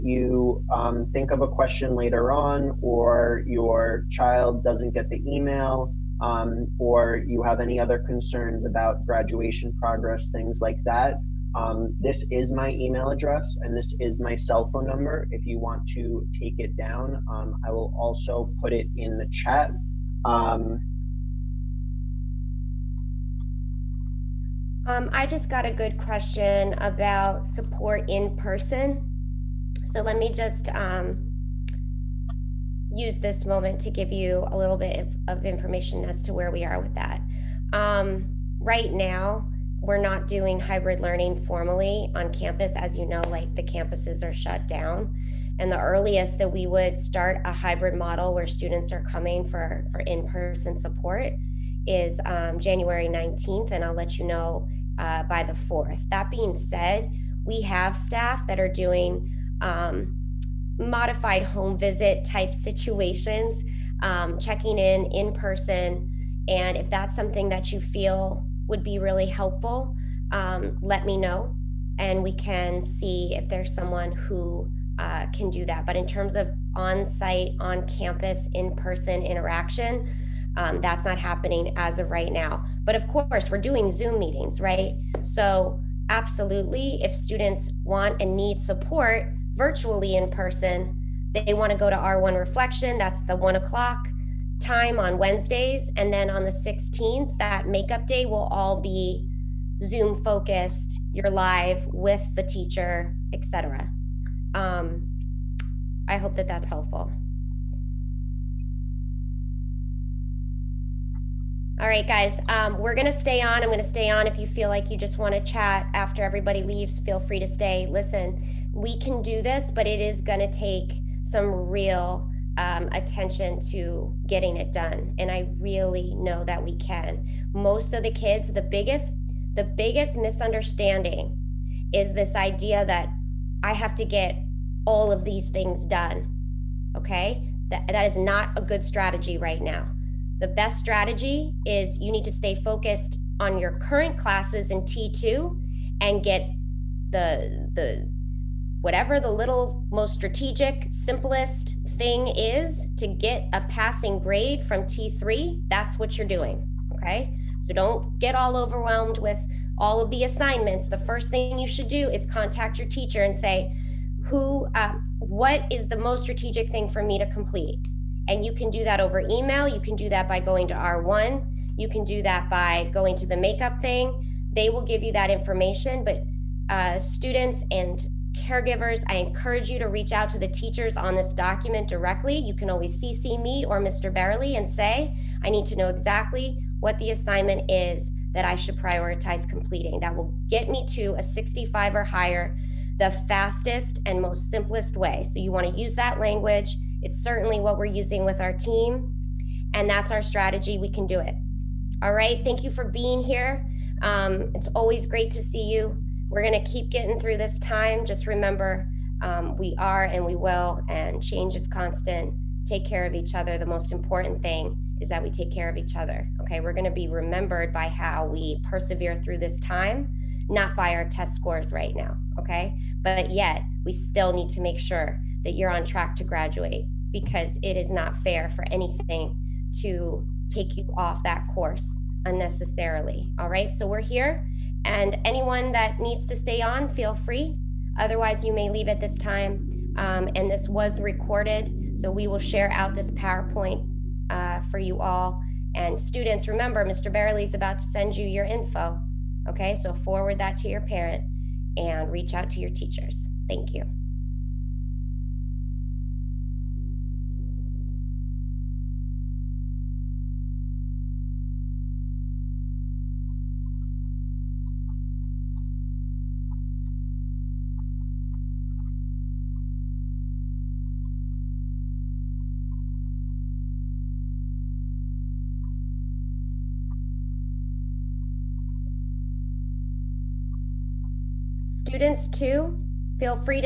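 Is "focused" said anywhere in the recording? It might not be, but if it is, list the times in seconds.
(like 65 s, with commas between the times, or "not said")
100 s, 142 s.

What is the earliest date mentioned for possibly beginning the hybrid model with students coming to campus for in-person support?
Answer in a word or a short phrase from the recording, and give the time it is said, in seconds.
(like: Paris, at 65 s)
January 19th, at 52 s.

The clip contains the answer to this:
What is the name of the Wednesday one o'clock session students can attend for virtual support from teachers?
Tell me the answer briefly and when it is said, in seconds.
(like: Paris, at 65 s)
R1 Reflection, at 91 s.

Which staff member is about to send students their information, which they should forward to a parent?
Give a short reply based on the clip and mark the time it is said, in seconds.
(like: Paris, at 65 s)
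Mr. Barley, at 246 s.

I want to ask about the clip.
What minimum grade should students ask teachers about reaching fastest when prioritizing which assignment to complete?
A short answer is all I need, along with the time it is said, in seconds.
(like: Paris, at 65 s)
65, at 191 s.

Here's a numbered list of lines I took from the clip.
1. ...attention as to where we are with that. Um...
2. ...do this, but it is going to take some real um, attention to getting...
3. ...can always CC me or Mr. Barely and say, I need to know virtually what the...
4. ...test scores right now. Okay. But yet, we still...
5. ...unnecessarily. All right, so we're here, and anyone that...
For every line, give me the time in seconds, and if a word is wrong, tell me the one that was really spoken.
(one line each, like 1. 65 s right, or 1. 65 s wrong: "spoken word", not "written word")
1. 35 s wrong: "information", not "attention"
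2. 119 s right
3. 182 s wrong: "exactly", not "virtually"
4. 221 s right
5. 232 s right.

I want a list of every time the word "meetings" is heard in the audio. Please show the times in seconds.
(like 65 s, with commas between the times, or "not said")
84 s.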